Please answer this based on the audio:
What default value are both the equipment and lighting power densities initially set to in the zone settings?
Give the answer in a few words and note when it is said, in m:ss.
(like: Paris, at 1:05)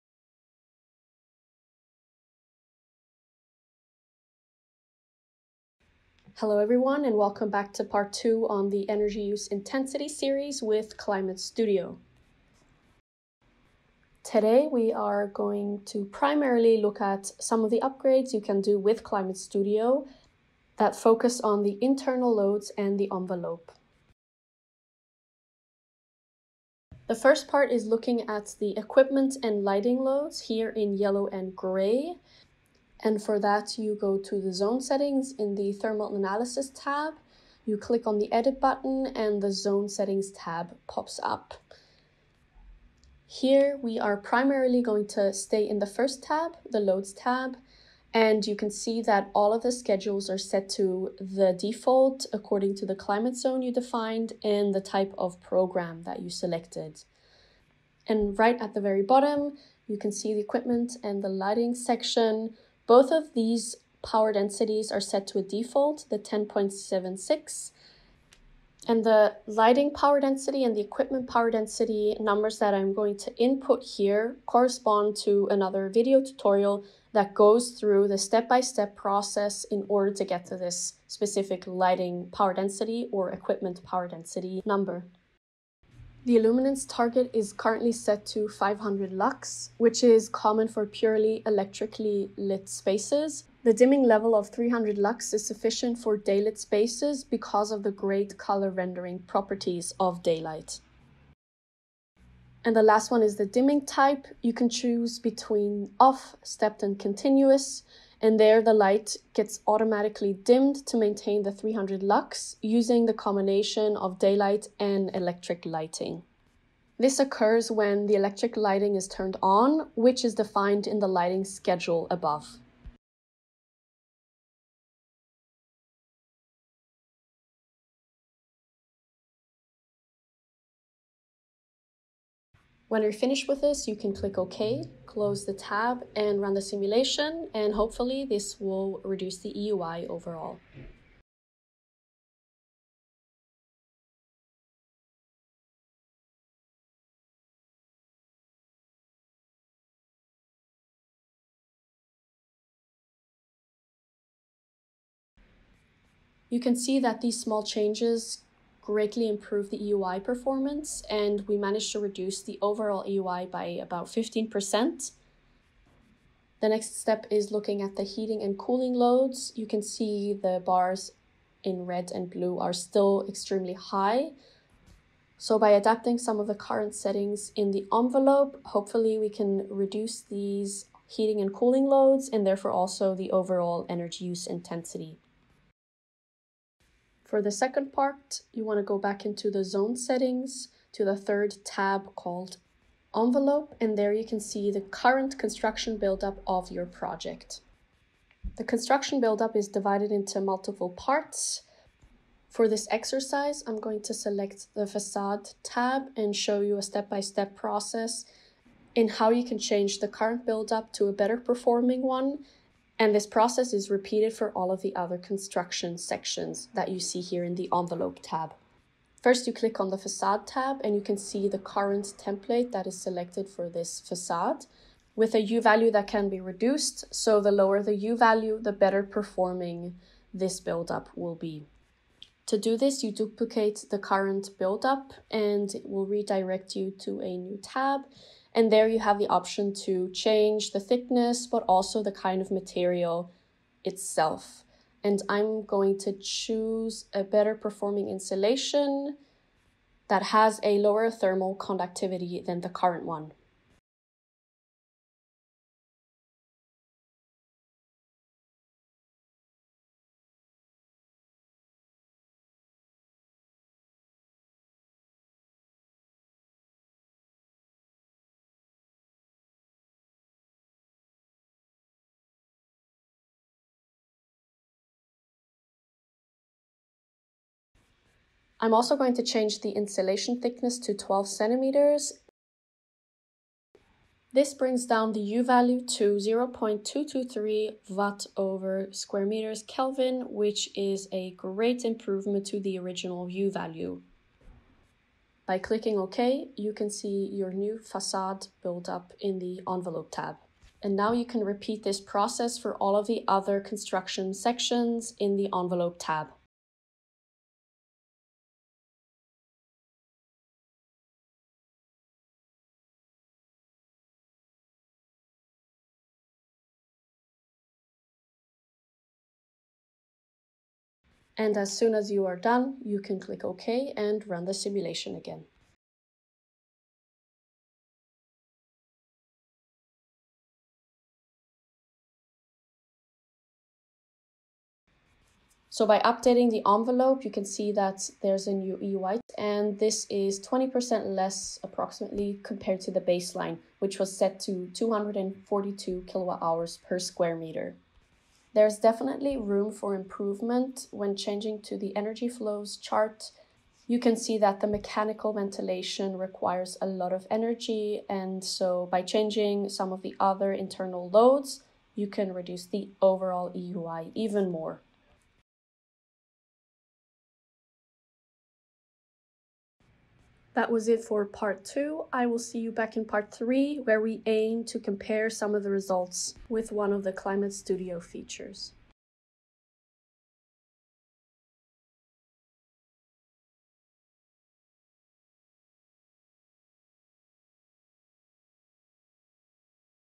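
10.76, at 1:06.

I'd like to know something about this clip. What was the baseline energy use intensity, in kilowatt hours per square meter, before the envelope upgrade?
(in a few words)
242.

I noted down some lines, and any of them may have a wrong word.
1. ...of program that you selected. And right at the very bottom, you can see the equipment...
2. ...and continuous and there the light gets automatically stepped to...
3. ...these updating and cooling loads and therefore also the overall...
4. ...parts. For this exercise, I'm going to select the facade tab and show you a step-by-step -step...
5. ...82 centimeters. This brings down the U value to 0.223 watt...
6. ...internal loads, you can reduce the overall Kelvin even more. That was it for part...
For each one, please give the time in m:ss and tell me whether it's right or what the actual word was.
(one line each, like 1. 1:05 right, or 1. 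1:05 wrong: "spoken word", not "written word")
1. 0:55 right
2. 1:46 wrong: "dimmed", not "stepped"
3. 3:00 wrong: "heating", not "updating"
4. 3:20 right
5. 4:40 wrong: "12", not "82"
6. 6:00 wrong: "EUI", not "Kelvin".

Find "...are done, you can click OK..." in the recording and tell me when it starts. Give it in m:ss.
5:22.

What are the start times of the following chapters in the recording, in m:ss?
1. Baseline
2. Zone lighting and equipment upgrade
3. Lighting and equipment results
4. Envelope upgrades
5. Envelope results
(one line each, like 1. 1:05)
1. 0:25
2. 0:42
3. 2:36
4. 3:06
5. 5:35.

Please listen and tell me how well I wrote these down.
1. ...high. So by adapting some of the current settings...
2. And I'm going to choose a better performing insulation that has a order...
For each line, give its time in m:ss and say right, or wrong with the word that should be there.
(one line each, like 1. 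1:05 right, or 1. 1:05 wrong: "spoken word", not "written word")
1. 2:53 right
2. 4:05 wrong: "lower", not "order".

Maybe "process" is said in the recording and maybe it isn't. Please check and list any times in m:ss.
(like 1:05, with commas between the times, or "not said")
1:19, 3:27, 3:33, 5:01.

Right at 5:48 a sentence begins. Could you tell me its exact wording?
There's definitely room for improvement when changing to the energy flows chart.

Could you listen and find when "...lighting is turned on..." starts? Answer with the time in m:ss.
1:58.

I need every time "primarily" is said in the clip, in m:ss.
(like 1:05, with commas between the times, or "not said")
0:16, 0:44.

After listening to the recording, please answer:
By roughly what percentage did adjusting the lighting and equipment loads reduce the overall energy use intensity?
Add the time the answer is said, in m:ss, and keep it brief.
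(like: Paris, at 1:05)
15%, at 2:44.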